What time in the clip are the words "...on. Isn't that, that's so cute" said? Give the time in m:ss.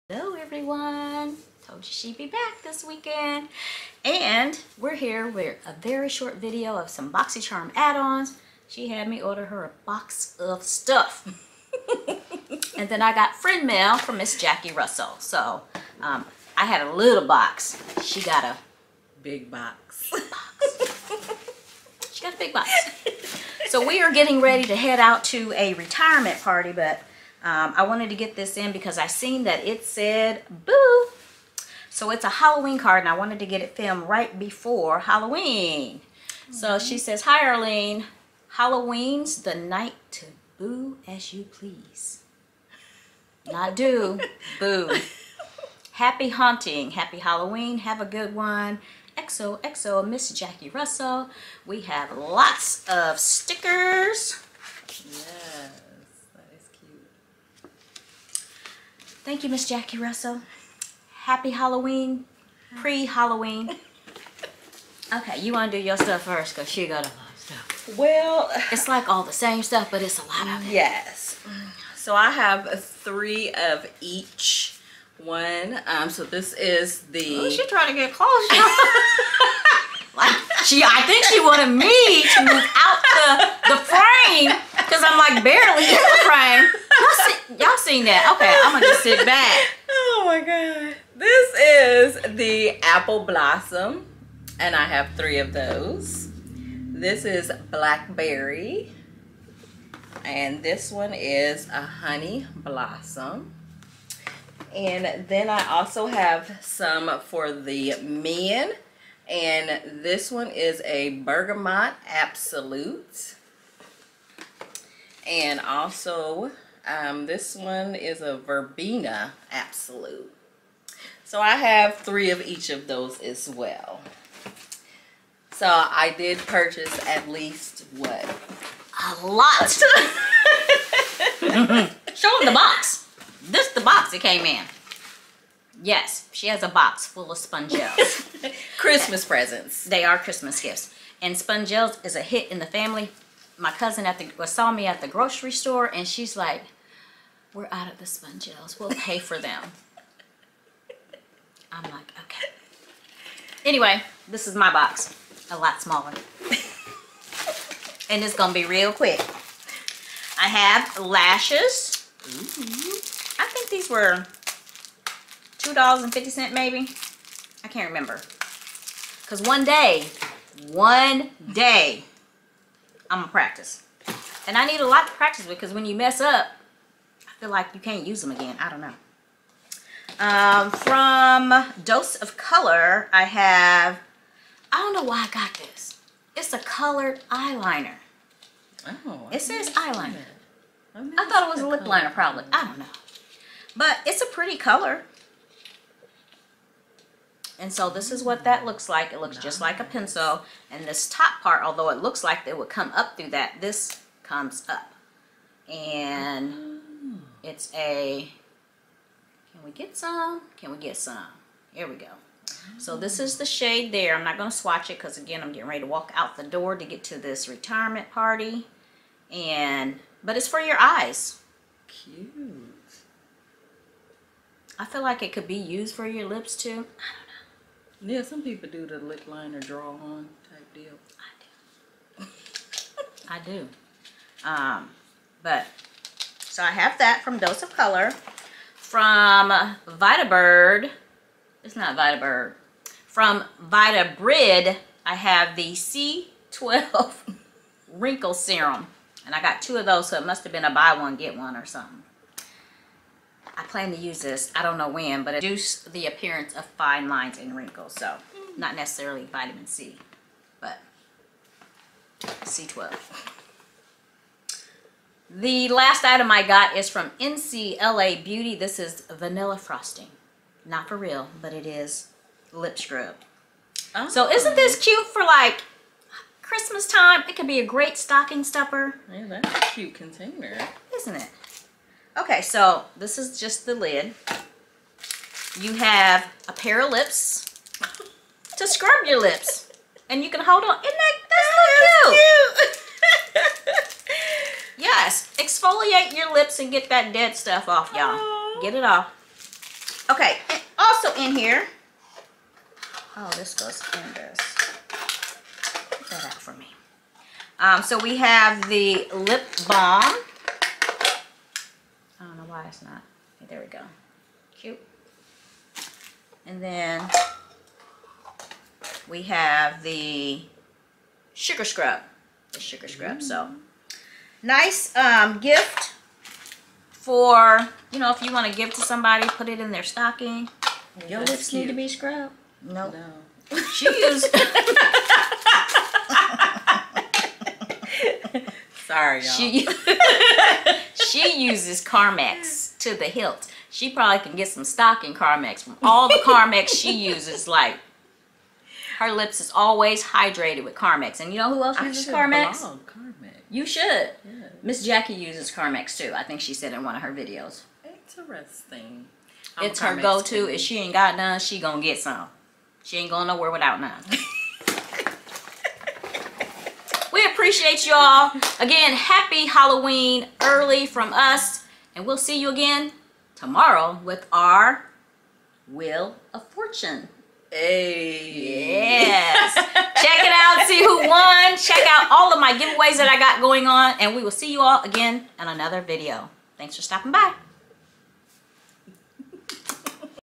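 4:50.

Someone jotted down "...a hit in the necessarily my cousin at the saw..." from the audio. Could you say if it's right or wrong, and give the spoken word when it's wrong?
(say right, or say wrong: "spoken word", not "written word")
wrong: "family", not "necessarily".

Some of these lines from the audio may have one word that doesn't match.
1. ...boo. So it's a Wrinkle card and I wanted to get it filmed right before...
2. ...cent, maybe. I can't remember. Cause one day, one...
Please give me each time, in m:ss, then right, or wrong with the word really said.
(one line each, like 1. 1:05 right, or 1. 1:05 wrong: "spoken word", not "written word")
1. 0:30 wrong: "Halloween", not "Wrinkle"
2. 2:46 right.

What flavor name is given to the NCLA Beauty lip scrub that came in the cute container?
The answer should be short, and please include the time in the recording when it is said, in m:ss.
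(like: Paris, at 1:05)
Vanilla frosting, at 4:29.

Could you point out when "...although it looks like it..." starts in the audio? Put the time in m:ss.
3:21.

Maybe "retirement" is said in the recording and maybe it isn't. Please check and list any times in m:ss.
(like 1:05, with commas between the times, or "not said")
0:25, 3:37.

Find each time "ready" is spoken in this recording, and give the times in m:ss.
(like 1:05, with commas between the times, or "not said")
0:24, 3:35.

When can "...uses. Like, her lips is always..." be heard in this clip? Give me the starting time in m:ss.
5:47.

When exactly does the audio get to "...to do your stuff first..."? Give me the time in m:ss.
1:05.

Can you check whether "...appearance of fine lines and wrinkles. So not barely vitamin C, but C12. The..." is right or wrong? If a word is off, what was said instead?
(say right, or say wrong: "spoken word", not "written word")
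wrong: "necessarily", not "barely".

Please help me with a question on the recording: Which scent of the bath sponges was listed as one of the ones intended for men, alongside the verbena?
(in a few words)
Bergamot absolute.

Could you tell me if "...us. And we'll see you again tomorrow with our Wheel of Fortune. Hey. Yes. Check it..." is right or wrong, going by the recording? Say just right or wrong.
right.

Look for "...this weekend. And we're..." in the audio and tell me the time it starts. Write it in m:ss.
0:02.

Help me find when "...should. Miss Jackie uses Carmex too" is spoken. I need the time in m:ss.
5:53.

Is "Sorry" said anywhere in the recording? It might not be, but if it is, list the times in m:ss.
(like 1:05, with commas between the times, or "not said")
5:38.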